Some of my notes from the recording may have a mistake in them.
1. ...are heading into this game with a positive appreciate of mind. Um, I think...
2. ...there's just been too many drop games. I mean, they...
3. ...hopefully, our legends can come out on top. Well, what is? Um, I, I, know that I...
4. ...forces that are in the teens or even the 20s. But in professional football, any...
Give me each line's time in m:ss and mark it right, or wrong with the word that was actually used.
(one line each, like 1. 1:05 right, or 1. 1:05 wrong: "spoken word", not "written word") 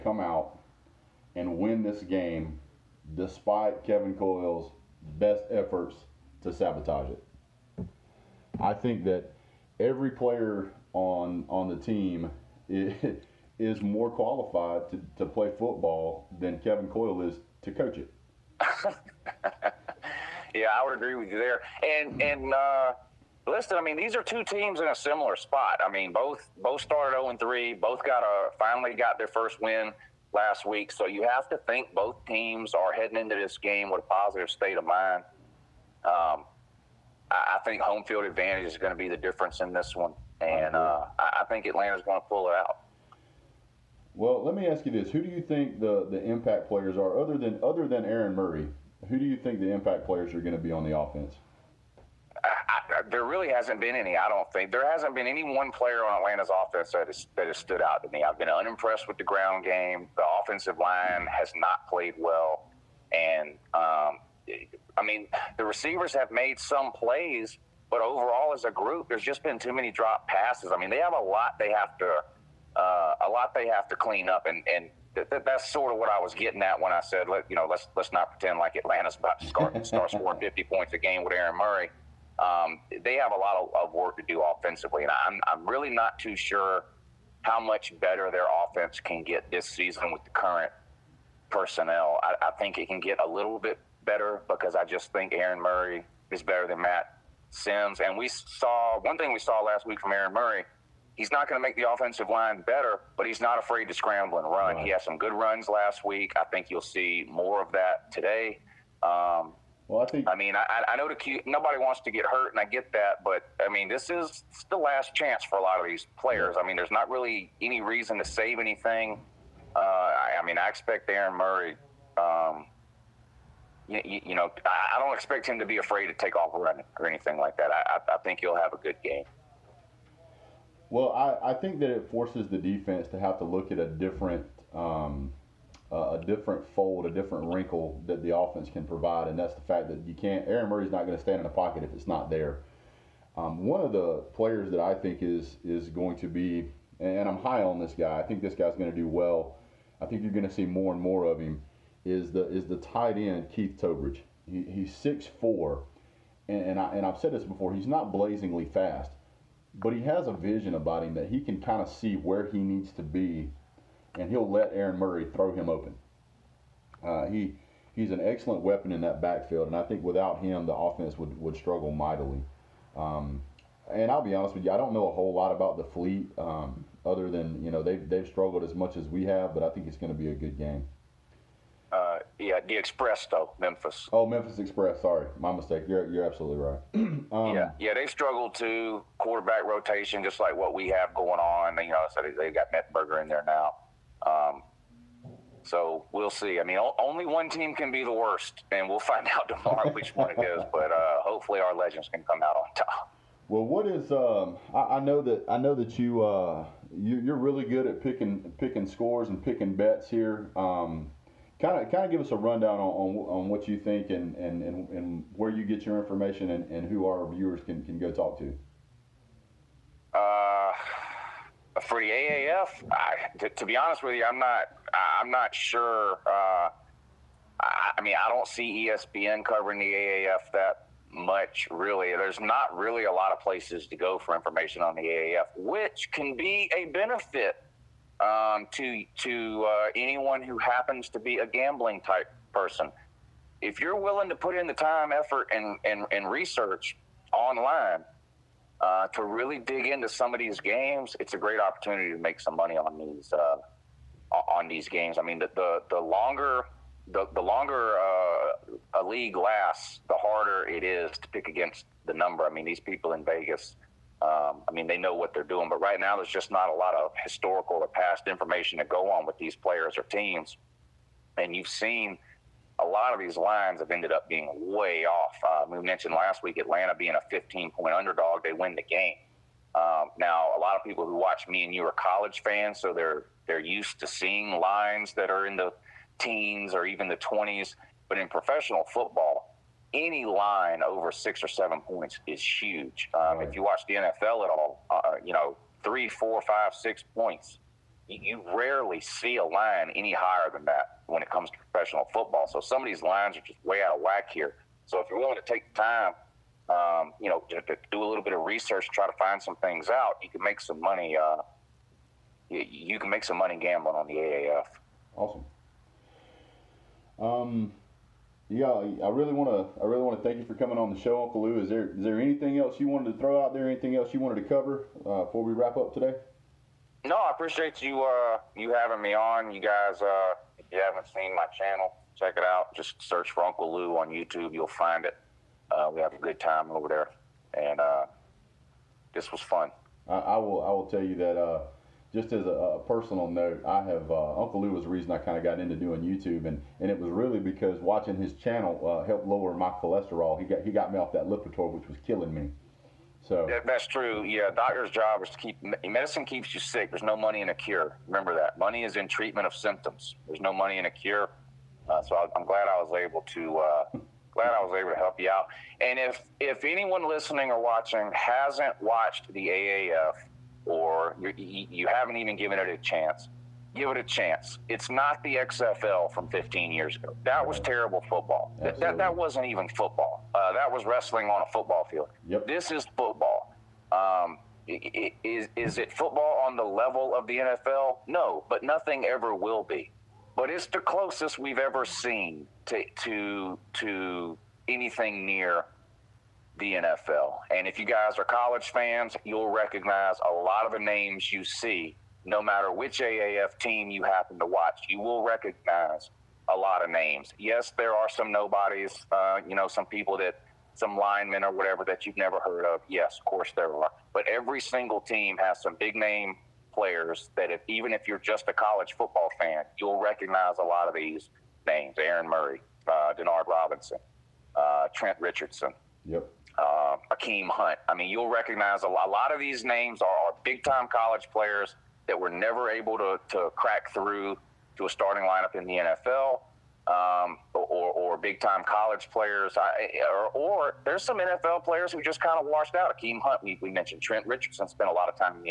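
1. 0:32 wrong: "state", not "appreciate"
2. 1:09 wrong: "passes", not "games"
3. 3:21 right
4. 4:44 wrong: "lines", not "forces".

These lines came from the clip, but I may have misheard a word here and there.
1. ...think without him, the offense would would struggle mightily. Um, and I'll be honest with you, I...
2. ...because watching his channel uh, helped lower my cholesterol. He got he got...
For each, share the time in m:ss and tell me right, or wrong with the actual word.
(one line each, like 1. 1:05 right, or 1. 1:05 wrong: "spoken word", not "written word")
1. 2:49 right
2. 5:47 right.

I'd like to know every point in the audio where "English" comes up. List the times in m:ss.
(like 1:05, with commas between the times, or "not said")
not said.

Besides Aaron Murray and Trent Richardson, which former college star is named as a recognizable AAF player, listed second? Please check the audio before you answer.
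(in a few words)
Denard Robinson.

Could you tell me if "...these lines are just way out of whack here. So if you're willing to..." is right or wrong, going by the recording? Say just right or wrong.
right.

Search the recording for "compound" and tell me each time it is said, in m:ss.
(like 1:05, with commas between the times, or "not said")
not said.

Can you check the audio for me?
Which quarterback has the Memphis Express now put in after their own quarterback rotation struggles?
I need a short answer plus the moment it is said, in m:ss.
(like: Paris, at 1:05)
Mettenberger, at 3:12.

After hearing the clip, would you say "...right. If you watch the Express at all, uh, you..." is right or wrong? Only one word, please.
wrong.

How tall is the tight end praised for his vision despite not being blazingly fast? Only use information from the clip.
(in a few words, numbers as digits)
6'4".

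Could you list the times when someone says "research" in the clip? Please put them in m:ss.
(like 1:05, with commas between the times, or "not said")
4:06, 5:08.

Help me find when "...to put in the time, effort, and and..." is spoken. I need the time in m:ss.
4:04.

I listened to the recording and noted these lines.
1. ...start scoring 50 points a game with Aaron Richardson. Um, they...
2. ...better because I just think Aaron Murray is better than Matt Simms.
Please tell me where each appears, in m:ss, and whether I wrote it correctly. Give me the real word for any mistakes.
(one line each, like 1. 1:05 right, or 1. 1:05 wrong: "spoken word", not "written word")
1. 1:19 wrong: "Murray", not "Richardson"
2. 1:34 right.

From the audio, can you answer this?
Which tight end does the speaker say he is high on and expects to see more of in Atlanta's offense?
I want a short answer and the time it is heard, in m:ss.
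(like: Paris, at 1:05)
Keith Towbridge, at 2:33.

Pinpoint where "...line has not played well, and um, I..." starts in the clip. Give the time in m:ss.
1:00.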